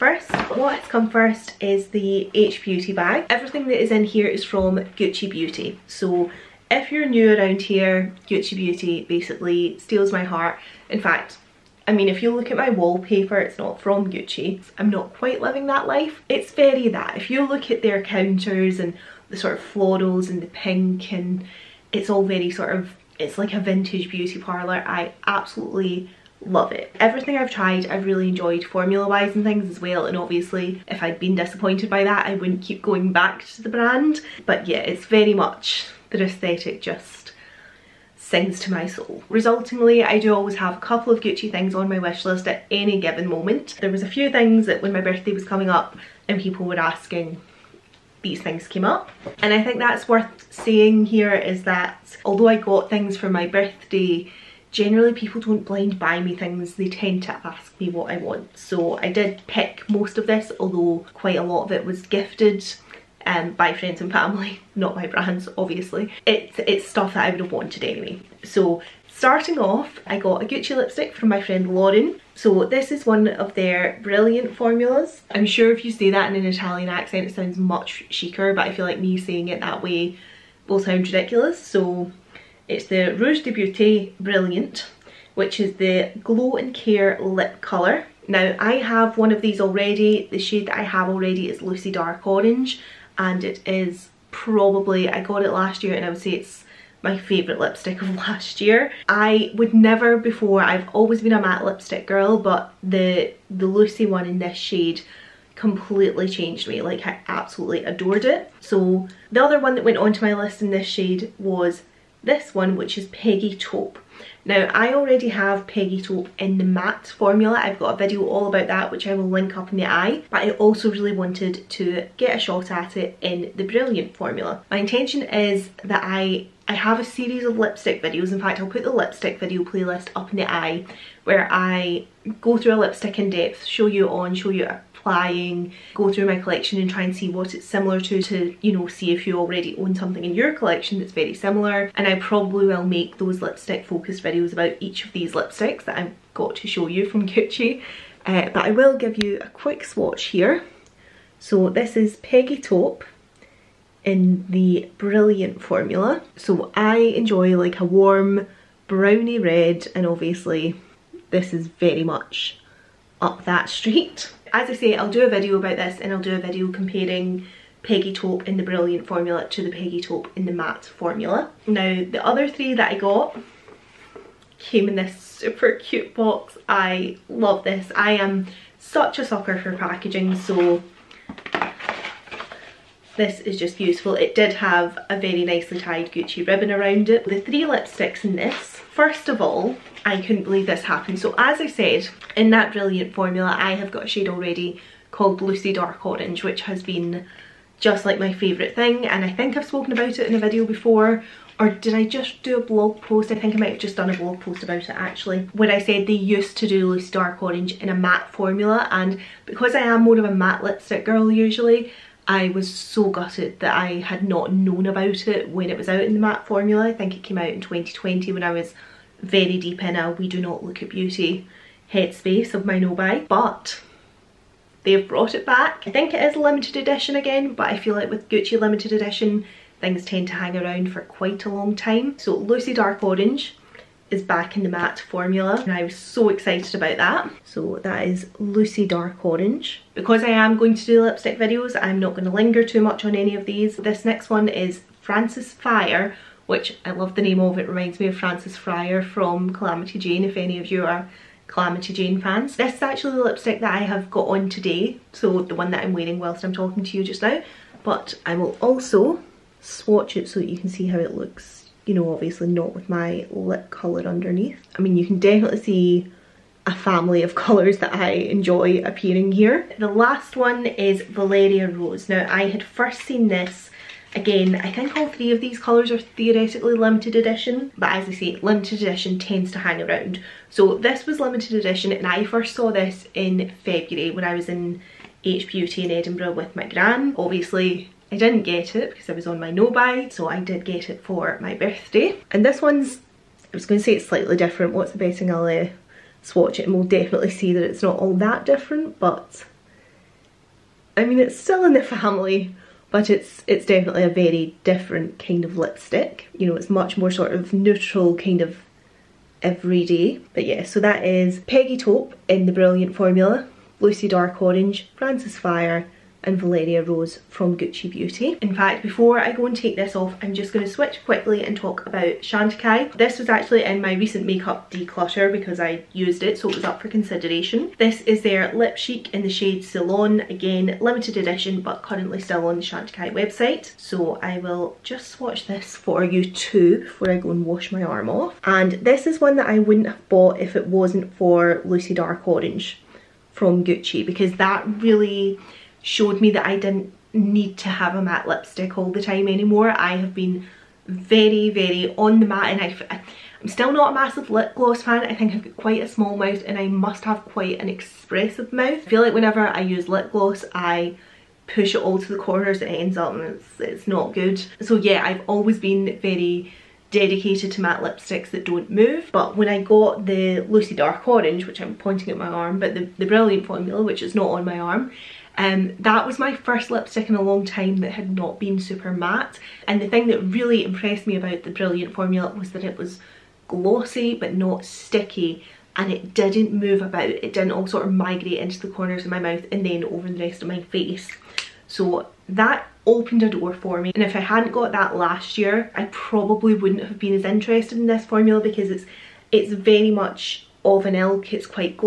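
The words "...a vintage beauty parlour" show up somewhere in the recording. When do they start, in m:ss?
0:23.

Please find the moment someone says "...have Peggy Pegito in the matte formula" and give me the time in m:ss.
1:55.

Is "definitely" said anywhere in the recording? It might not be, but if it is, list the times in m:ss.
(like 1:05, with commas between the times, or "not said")
4:25, 4:56, 5:03.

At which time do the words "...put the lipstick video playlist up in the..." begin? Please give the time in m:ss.
2:08.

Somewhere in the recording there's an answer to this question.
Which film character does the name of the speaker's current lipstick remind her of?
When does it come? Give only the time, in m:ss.
4:08.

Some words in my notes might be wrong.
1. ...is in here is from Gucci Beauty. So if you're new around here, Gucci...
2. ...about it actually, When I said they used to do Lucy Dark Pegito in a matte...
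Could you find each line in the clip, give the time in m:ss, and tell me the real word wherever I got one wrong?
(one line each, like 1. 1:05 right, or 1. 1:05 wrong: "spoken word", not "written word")
1. 0:03 right
2. 3:24 wrong: "Orange", not "Pegito".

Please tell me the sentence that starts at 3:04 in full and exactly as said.
It did have a very nicely tied Gucci ribbon around it.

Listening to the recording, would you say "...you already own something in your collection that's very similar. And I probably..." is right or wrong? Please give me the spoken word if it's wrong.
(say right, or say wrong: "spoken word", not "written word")
right.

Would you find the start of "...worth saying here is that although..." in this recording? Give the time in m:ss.
0:50.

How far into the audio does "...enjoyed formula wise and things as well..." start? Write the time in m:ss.
0:28.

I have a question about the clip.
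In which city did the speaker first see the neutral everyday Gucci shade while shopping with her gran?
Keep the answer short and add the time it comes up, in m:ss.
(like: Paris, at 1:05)
Edinburgh, at 4:45.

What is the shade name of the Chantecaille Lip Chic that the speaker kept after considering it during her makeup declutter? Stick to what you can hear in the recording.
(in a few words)
Ceylon.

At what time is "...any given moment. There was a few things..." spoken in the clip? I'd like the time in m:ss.
0:42.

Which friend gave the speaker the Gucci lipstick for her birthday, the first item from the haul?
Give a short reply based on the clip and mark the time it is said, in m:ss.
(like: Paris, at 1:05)
Lauren, at 1:11.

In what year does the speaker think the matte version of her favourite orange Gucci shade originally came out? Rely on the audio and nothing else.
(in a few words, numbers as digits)
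2020.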